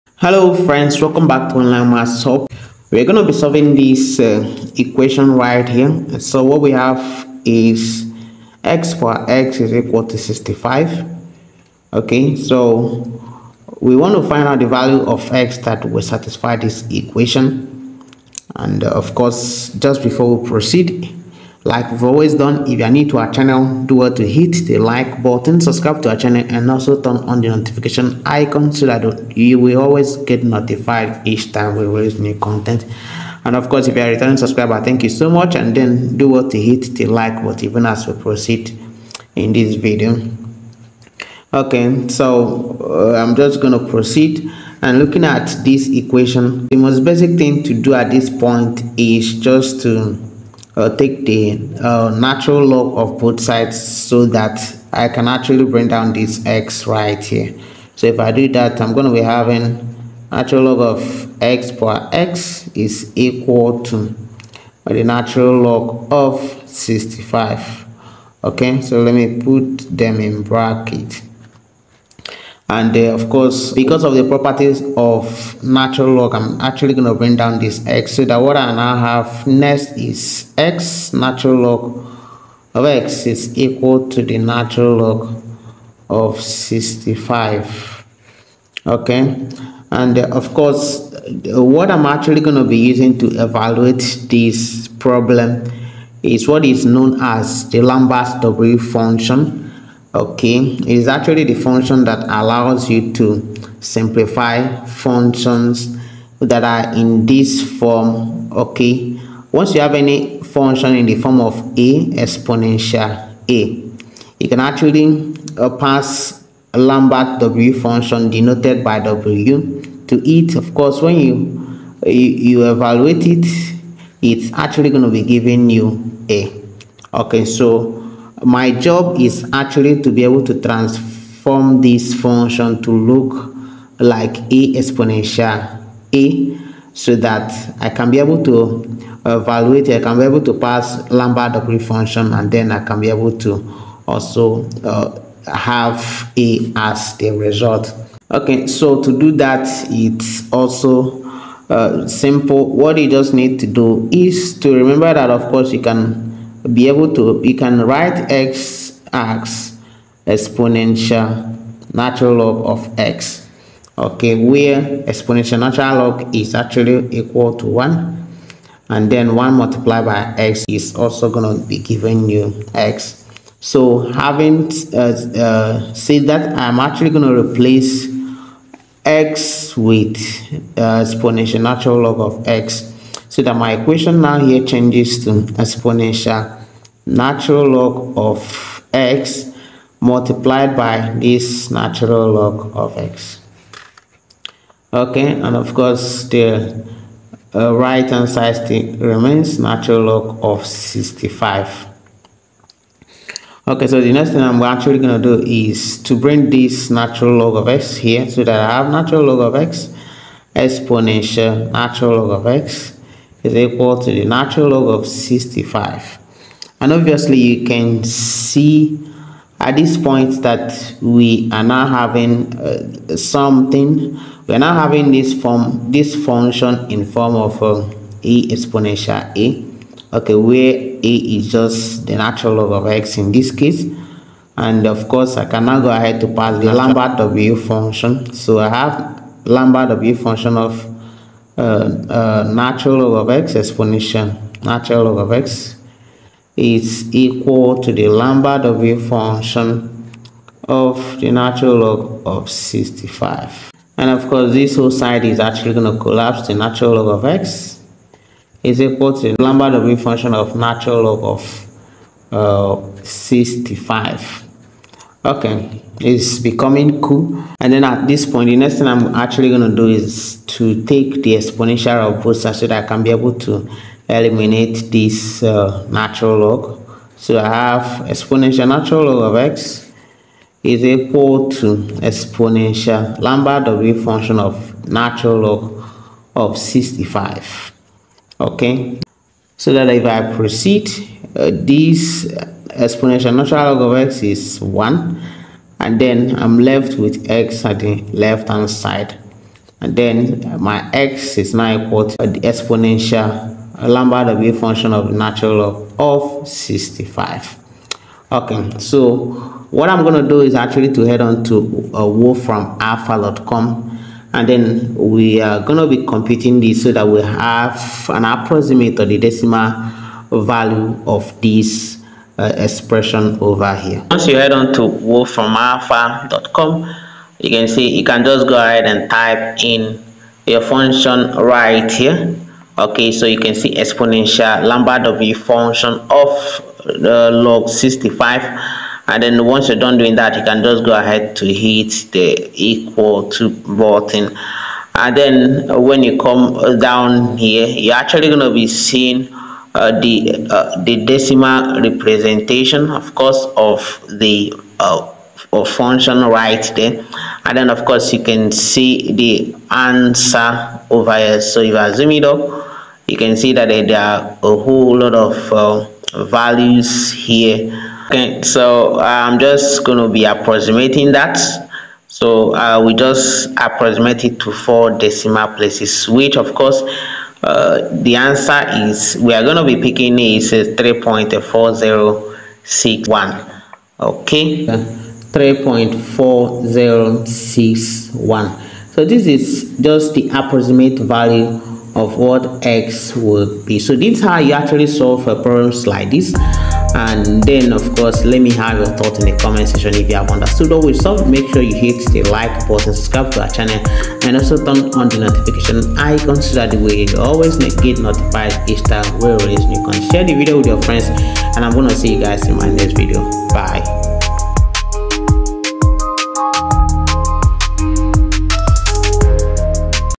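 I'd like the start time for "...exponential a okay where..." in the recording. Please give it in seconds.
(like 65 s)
228 s.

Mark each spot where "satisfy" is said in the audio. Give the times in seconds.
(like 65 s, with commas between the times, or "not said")
16 s.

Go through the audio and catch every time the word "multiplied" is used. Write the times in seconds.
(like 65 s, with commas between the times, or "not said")
169 s, 190 s.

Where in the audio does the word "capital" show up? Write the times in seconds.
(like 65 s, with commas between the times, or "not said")
not said.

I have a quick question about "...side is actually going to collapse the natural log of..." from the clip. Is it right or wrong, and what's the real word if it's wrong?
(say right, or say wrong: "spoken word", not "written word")
right.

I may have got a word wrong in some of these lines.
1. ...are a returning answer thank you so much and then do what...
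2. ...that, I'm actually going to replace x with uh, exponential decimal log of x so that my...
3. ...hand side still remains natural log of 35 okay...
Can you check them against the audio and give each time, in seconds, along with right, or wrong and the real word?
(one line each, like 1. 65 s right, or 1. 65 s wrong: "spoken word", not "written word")
1. 34 s wrong: "subscriber", not "answer"
2. 176 s wrong: "natural", not "decimal"
3. 198 s wrong: "65", not "35".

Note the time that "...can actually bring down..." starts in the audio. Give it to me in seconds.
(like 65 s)
55 s.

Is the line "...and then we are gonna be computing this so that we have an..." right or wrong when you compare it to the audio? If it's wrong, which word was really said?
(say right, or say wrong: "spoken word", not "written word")
right.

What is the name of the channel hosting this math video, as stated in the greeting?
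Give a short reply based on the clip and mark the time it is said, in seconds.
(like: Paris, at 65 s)
Online Math Hub, at 1 s.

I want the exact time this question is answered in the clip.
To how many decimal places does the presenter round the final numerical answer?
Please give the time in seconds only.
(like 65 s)
374 s.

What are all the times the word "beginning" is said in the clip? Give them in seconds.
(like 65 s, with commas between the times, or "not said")
not said.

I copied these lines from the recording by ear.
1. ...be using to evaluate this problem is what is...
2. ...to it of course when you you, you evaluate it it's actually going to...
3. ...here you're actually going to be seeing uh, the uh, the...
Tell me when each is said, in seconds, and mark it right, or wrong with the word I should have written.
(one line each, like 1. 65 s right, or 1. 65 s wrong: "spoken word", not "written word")
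1. 92 s right
2. 120 s right
3. 347 s right.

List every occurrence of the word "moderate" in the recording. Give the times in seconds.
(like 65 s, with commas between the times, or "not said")
not said.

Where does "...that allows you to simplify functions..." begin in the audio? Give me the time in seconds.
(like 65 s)
102 s.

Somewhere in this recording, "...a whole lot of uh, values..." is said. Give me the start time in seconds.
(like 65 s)
364 s.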